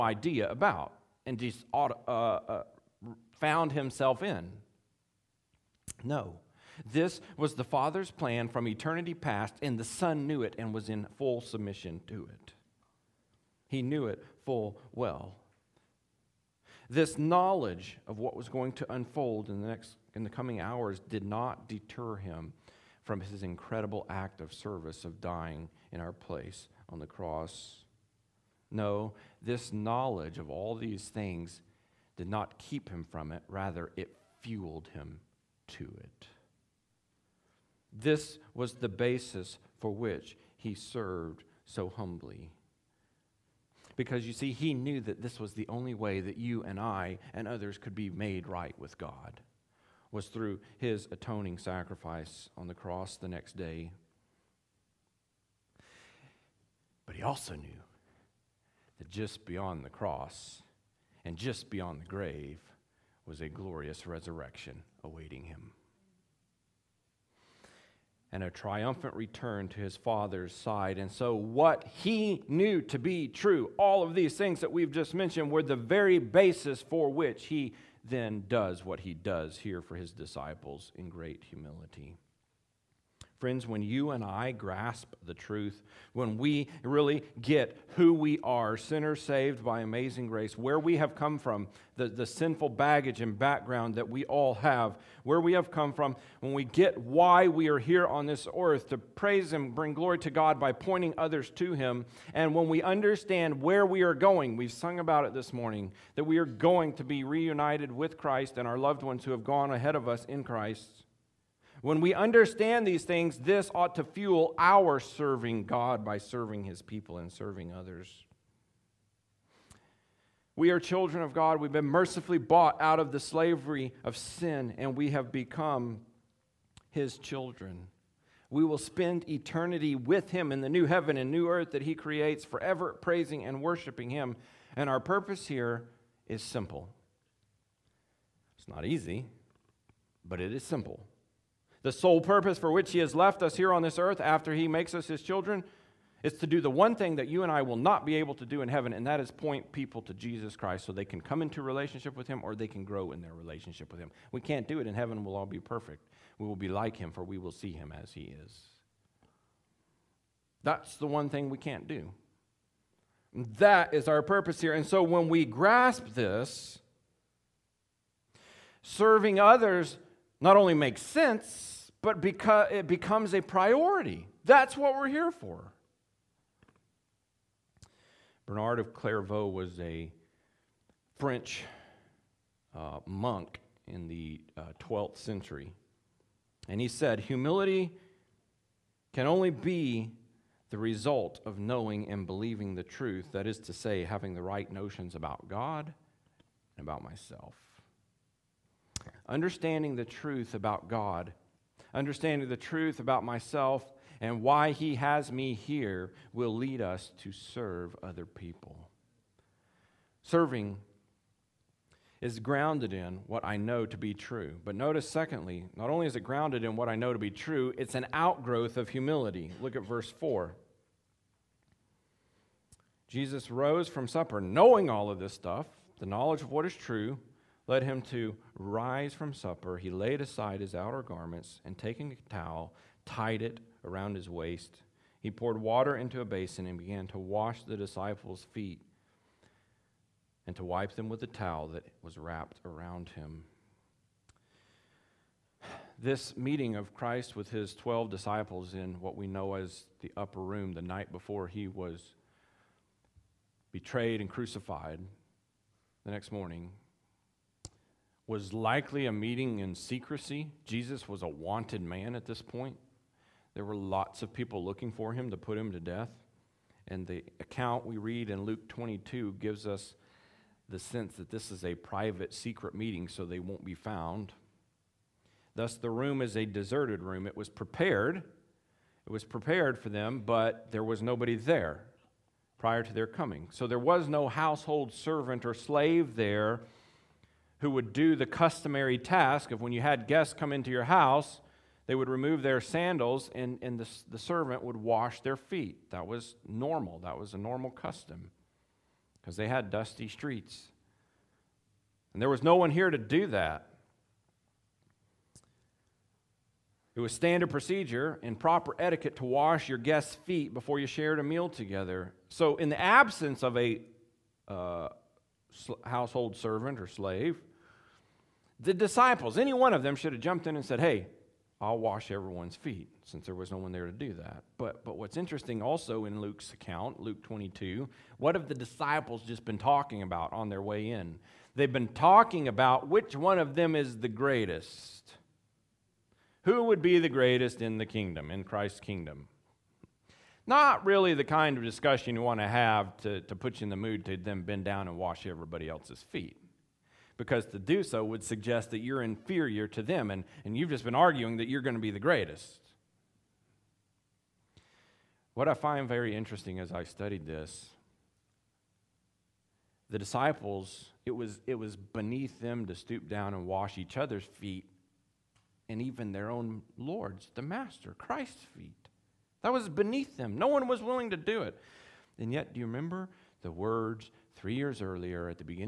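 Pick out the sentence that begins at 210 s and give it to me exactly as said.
Serving is grounded in what I know to be true.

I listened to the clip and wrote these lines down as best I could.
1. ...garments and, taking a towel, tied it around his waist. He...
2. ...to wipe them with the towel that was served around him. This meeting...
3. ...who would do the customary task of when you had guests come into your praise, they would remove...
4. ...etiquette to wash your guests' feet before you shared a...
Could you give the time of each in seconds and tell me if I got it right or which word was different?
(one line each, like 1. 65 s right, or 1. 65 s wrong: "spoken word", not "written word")
1. 231 s right
2. 240 s wrong: "wrapped", not "served"
3. 287 s wrong: "house", not "praise"
4. 308 s right.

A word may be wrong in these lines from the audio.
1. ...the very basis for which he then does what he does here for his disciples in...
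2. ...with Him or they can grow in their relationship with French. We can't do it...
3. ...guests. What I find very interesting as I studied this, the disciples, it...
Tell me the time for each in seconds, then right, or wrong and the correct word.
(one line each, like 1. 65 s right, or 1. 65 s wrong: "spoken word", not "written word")
1. 75 s right
2. 152 s wrong: "Him", not "French"
3. 351 s wrong: "greatest", not "guests".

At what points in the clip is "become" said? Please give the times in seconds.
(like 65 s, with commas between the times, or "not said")
125 s, 172 s.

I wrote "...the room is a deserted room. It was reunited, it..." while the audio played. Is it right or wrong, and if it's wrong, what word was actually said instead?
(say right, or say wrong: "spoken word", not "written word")
wrong: "prepared", not "reunited".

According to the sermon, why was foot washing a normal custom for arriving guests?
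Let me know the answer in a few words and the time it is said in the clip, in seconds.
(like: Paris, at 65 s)
Dusty streets, at 299 s.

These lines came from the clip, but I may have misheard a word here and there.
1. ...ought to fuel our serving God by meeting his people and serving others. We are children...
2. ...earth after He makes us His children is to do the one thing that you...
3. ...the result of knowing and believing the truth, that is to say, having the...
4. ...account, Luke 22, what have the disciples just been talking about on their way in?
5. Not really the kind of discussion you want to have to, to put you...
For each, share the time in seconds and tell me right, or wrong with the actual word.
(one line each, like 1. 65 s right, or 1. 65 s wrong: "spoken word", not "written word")
1. 113 s wrong: "serving", not "meeting"
2. 143 s right
3. 190 s right
4. 326 s right
5. 340 s right.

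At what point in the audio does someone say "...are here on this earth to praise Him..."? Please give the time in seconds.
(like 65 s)
97 s.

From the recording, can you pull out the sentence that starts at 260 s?
Jesus was a wanted man at this point.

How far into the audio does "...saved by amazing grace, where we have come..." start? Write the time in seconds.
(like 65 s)
89 s.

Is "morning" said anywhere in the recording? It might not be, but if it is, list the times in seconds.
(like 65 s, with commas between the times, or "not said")
105 s, 256 s.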